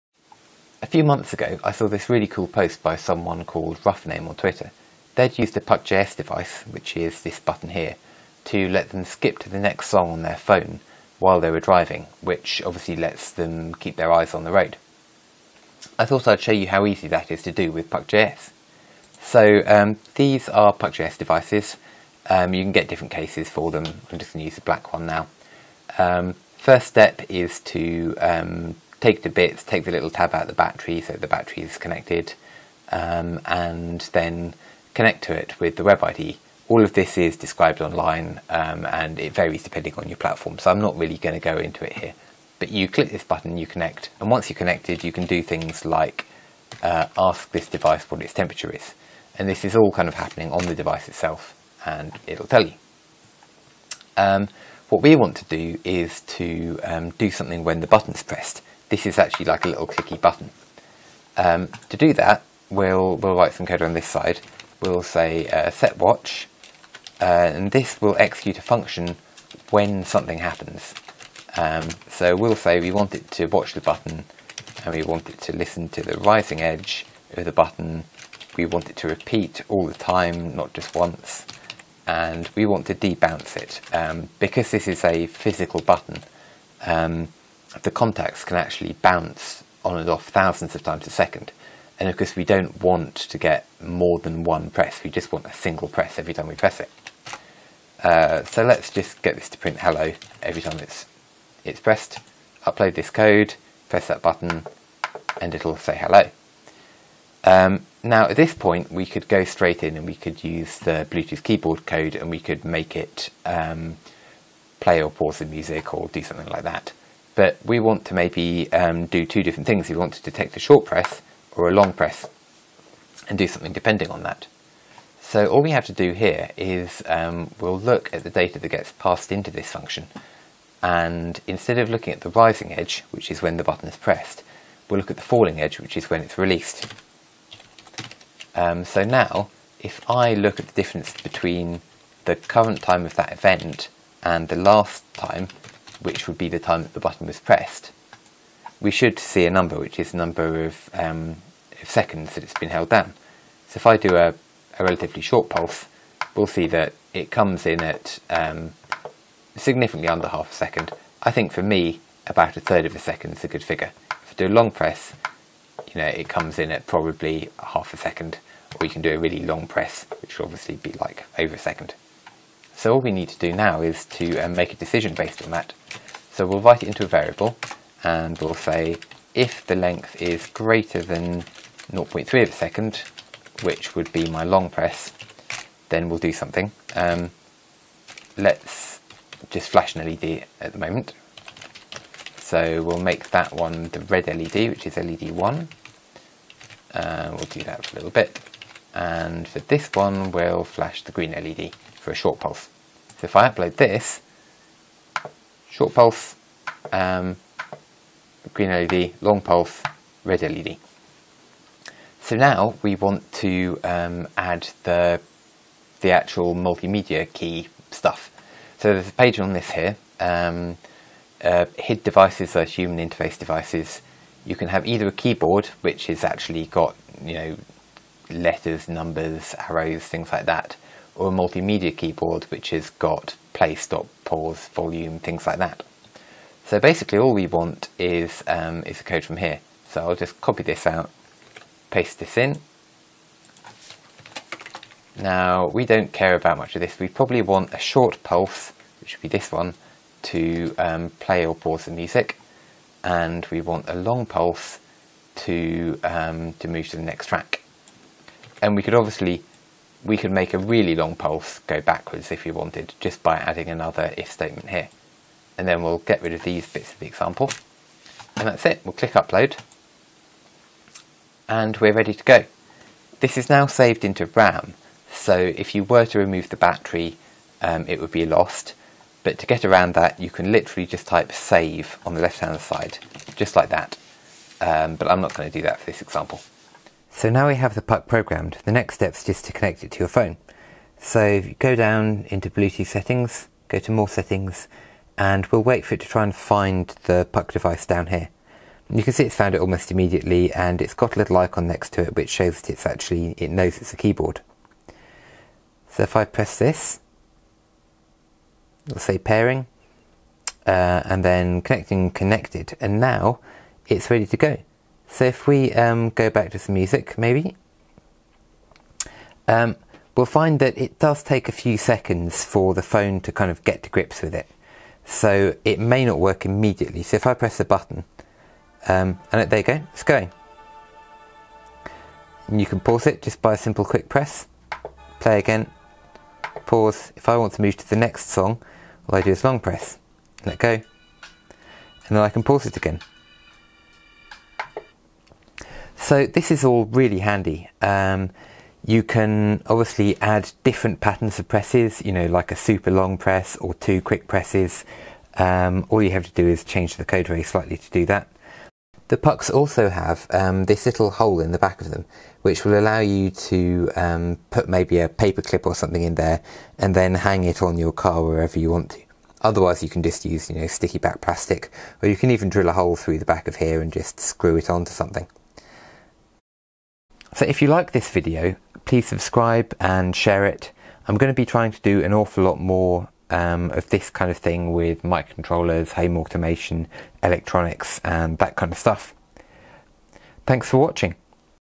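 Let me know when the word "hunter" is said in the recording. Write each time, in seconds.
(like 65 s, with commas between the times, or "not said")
not said.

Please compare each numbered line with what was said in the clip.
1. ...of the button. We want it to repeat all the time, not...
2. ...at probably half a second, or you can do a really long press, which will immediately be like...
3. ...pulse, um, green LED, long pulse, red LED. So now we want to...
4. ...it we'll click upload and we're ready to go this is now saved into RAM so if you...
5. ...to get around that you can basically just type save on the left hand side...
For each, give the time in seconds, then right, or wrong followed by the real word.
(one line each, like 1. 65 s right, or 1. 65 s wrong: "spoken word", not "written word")
1. 77 s right
2. 166 s wrong: "obviously", not "immediately"
3. 205 s right
4. 268 s right
5. 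279 s wrong: "literally", not "basically".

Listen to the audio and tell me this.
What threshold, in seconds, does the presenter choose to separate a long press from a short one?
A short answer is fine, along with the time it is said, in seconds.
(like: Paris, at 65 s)
0.3, at 181 s.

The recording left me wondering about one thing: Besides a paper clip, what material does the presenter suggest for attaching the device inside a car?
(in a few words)
sticky back plastic.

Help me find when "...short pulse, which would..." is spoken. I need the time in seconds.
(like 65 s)
247 s.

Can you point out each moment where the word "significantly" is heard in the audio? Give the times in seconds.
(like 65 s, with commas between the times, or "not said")
159 s.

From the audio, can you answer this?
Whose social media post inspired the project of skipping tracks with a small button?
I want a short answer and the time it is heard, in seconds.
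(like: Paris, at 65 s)
Roughname, at 3 s.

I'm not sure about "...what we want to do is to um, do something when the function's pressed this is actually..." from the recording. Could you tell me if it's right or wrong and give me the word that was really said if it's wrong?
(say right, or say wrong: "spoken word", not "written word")
wrong: "button", not "function".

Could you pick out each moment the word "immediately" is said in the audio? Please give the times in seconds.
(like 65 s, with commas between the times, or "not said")
299 s, 326 s.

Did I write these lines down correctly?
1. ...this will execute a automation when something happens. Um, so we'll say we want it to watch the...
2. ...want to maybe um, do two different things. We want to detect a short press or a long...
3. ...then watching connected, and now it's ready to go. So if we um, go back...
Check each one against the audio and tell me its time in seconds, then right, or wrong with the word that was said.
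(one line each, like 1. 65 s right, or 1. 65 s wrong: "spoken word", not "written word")
1. 67 s wrong: "function", not "automation"
2. 117 s right
3. 311 s wrong: "connecting", not "watching".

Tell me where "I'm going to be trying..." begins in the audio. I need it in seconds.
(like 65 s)
381 s.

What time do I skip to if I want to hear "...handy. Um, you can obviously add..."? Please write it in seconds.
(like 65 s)
347 s.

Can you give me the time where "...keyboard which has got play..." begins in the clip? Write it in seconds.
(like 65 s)
231 s.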